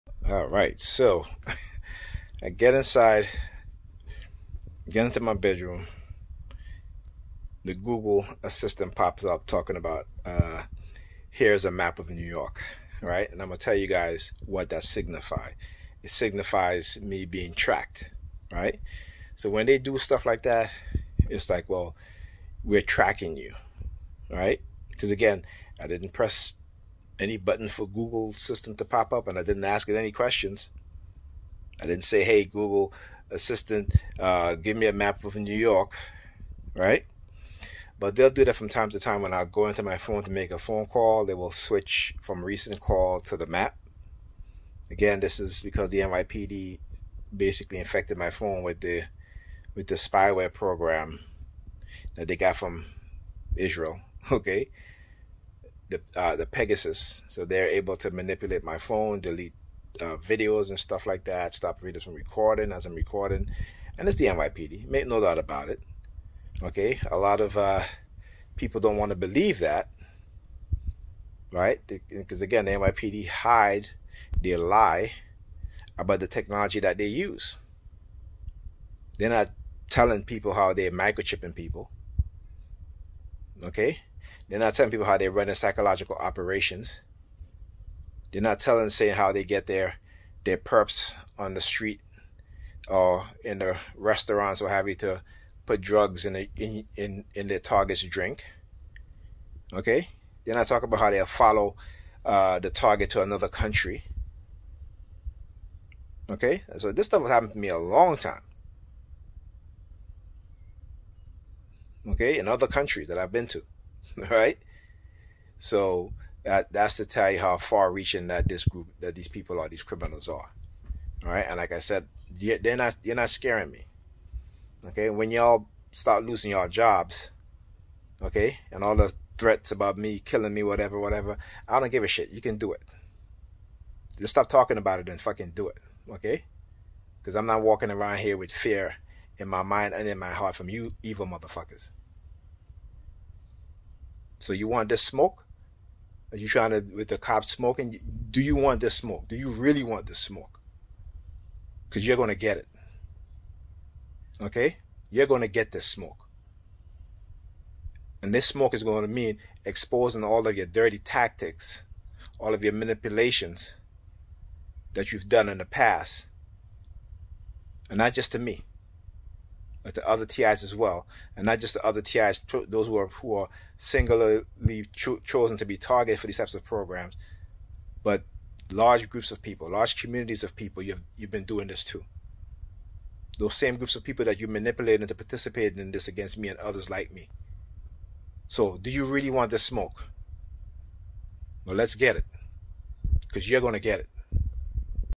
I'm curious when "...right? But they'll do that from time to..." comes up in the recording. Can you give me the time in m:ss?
0:36.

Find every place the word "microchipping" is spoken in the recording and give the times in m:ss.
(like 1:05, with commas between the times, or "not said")
1:20.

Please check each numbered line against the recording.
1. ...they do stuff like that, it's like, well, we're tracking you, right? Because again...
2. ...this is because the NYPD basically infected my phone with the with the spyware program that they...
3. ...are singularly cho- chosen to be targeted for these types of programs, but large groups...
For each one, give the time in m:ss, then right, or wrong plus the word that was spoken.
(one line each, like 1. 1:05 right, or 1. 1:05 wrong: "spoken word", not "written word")
1. 0:19 right
2. 0:45 right
3. 2:53 right.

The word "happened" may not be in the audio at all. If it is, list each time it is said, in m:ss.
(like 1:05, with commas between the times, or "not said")
1:47.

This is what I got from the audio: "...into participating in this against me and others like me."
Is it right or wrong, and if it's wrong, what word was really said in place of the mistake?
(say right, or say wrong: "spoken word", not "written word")
right.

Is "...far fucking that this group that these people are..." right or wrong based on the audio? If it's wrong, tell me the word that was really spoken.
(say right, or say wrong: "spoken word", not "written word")
wrong: "reaching", not "fucking".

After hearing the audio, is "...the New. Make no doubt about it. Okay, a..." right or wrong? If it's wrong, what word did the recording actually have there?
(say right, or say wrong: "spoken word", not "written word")
wrong: "NYPD", not "New".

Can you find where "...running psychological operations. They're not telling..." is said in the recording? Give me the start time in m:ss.
1:25.